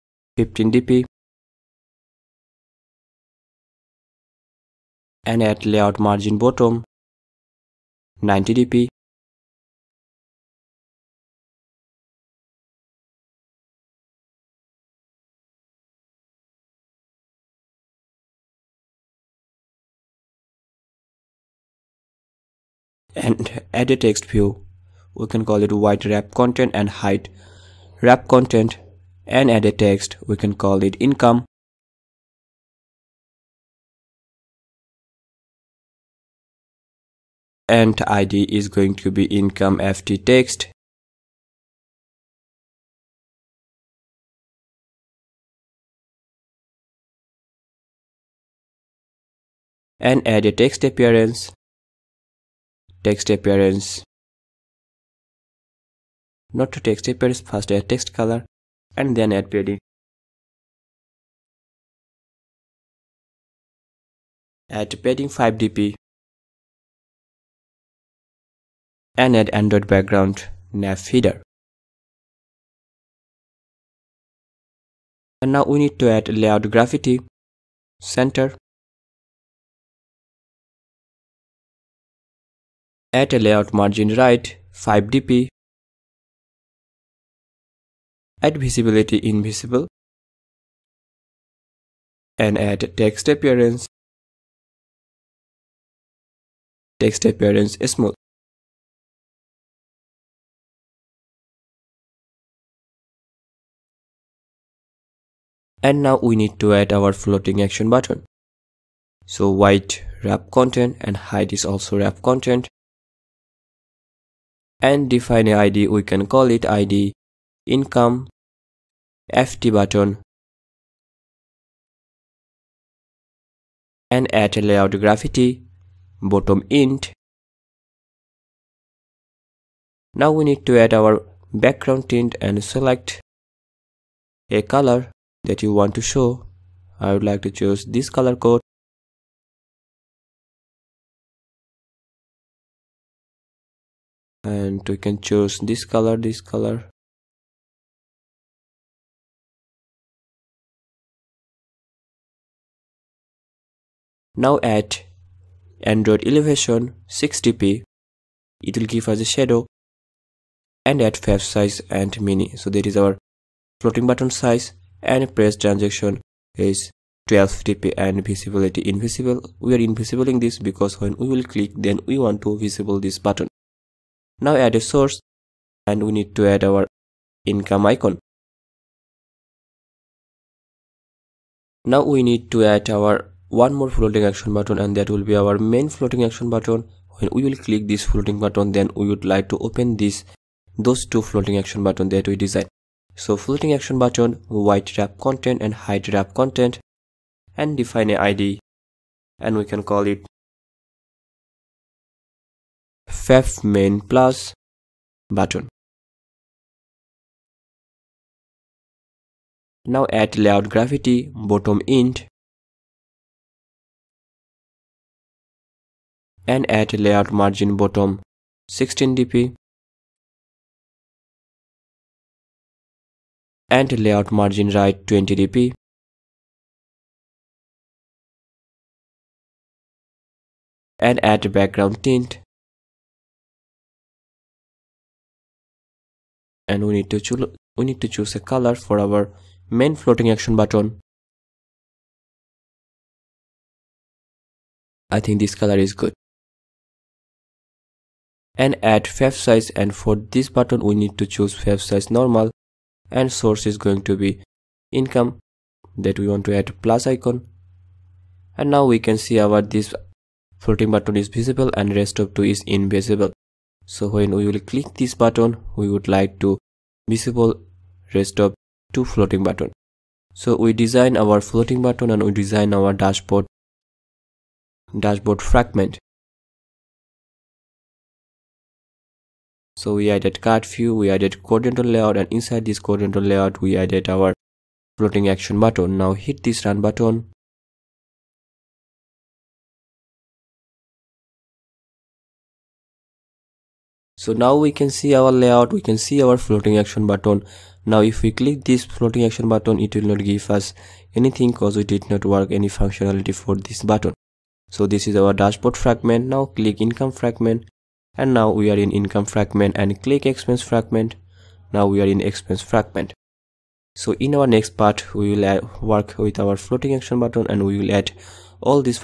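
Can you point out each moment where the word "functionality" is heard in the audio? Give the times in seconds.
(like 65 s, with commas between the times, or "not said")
302 s.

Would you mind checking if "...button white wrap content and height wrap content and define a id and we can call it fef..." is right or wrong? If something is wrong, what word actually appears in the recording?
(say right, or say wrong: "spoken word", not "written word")
right.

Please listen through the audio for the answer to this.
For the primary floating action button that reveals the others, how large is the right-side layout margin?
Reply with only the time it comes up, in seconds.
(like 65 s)
225 s.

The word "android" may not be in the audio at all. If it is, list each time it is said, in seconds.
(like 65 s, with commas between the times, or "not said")
69 s, 155 s.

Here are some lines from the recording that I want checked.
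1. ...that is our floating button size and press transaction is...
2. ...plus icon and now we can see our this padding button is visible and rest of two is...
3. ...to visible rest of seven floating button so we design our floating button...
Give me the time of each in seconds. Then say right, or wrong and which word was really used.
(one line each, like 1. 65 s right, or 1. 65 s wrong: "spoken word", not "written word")
1. 162 s right
2. 256 s wrong: "floating", not "padding"
3. 266 s wrong: "two", not "seven".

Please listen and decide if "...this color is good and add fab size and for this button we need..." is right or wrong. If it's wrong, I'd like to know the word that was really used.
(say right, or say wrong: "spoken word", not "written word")
right.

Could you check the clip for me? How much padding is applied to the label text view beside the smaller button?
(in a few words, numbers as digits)
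5 dp.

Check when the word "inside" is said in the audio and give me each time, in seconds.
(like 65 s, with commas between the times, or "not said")
282 s.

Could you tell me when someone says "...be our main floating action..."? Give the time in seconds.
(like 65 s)
185 s.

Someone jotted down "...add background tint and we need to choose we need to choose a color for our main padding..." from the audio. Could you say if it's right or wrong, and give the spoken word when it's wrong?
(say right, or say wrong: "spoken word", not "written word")
wrong: "floating", not "padding".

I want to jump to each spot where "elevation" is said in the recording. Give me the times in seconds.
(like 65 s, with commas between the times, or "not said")
156 s.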